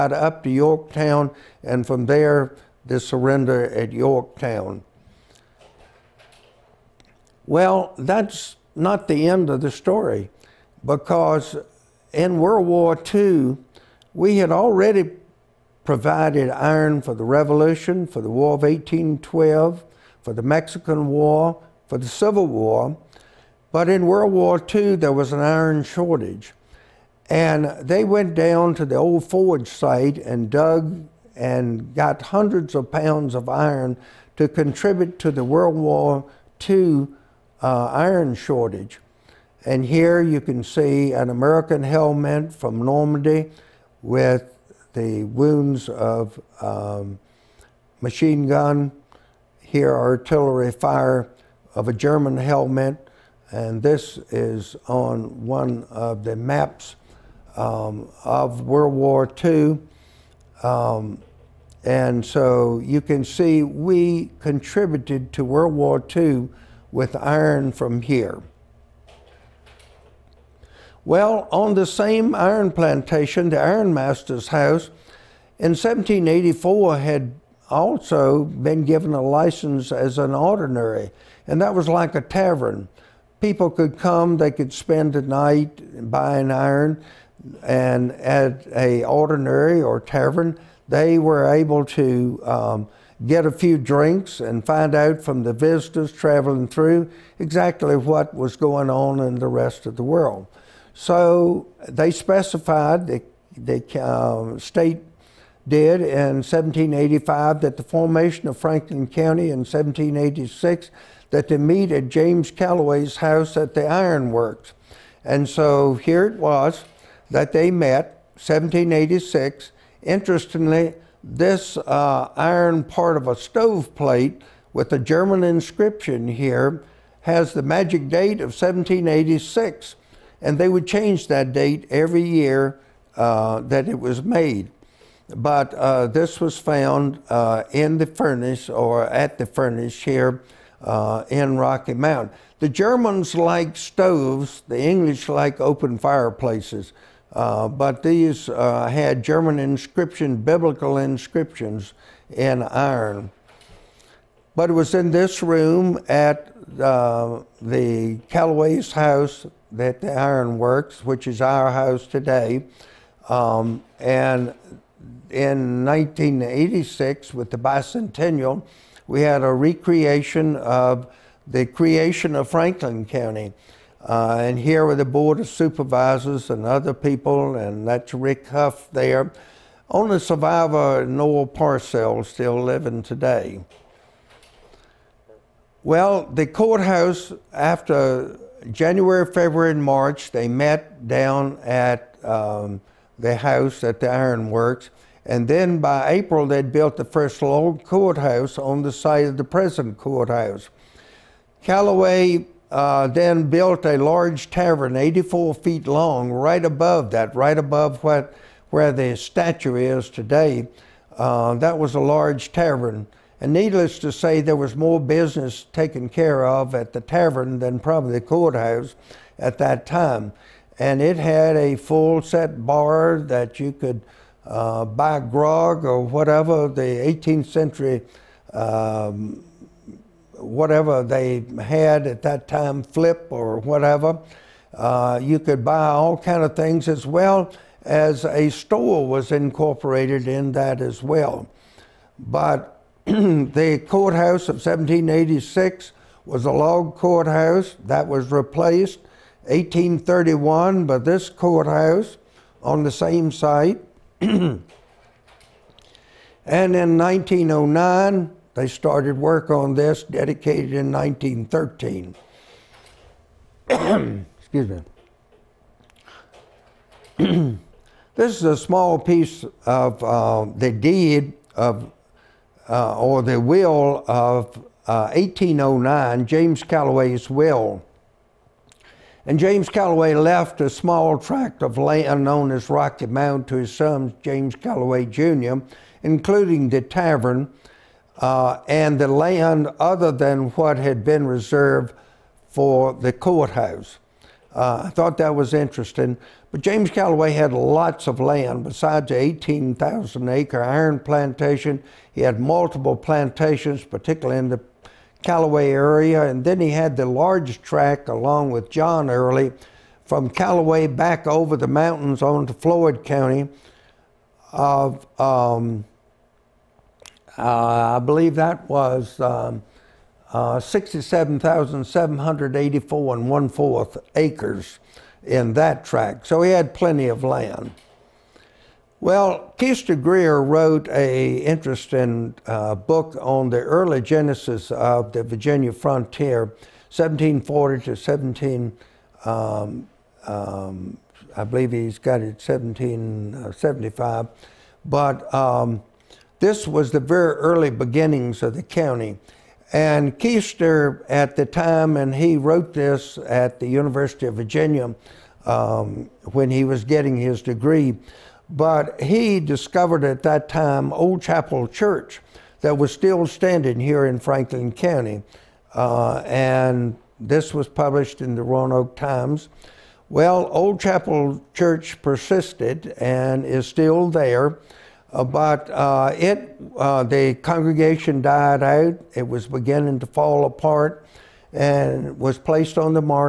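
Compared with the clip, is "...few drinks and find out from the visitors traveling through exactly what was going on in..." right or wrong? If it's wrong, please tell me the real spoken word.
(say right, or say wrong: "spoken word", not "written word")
right.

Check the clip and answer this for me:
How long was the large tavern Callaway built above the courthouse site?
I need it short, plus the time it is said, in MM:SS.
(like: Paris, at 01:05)
84 feet, at 03:24.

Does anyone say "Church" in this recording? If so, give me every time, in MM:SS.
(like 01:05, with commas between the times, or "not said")
06:01, 06:11.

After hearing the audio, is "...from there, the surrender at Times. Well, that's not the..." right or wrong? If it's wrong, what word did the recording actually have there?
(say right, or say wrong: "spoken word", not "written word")
wrong: "Yorktown", not "Times".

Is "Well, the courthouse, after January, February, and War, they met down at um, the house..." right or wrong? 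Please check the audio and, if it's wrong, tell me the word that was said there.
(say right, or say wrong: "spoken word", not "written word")
wrong: "March", not "War".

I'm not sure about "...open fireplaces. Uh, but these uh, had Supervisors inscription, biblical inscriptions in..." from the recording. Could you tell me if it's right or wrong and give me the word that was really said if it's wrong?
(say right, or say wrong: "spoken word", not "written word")
wrong: "German", not "Supervisors".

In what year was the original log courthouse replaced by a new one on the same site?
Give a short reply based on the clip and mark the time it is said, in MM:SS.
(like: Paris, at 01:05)
1831, at 04:09.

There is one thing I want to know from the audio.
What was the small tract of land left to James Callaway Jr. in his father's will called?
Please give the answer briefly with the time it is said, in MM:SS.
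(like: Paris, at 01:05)
Rocky Mound, at 04:42.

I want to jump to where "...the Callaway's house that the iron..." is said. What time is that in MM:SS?
02:37.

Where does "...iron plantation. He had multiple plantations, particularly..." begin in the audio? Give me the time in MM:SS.
05:00.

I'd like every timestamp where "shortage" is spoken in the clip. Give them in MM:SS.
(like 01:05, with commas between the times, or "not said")
00:25, 00:38.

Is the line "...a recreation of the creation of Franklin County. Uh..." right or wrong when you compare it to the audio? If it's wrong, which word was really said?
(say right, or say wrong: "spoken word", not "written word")
right.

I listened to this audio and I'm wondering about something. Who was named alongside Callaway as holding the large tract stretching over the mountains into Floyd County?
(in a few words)
John Early.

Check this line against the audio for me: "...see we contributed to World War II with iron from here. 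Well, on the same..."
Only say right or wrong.
right.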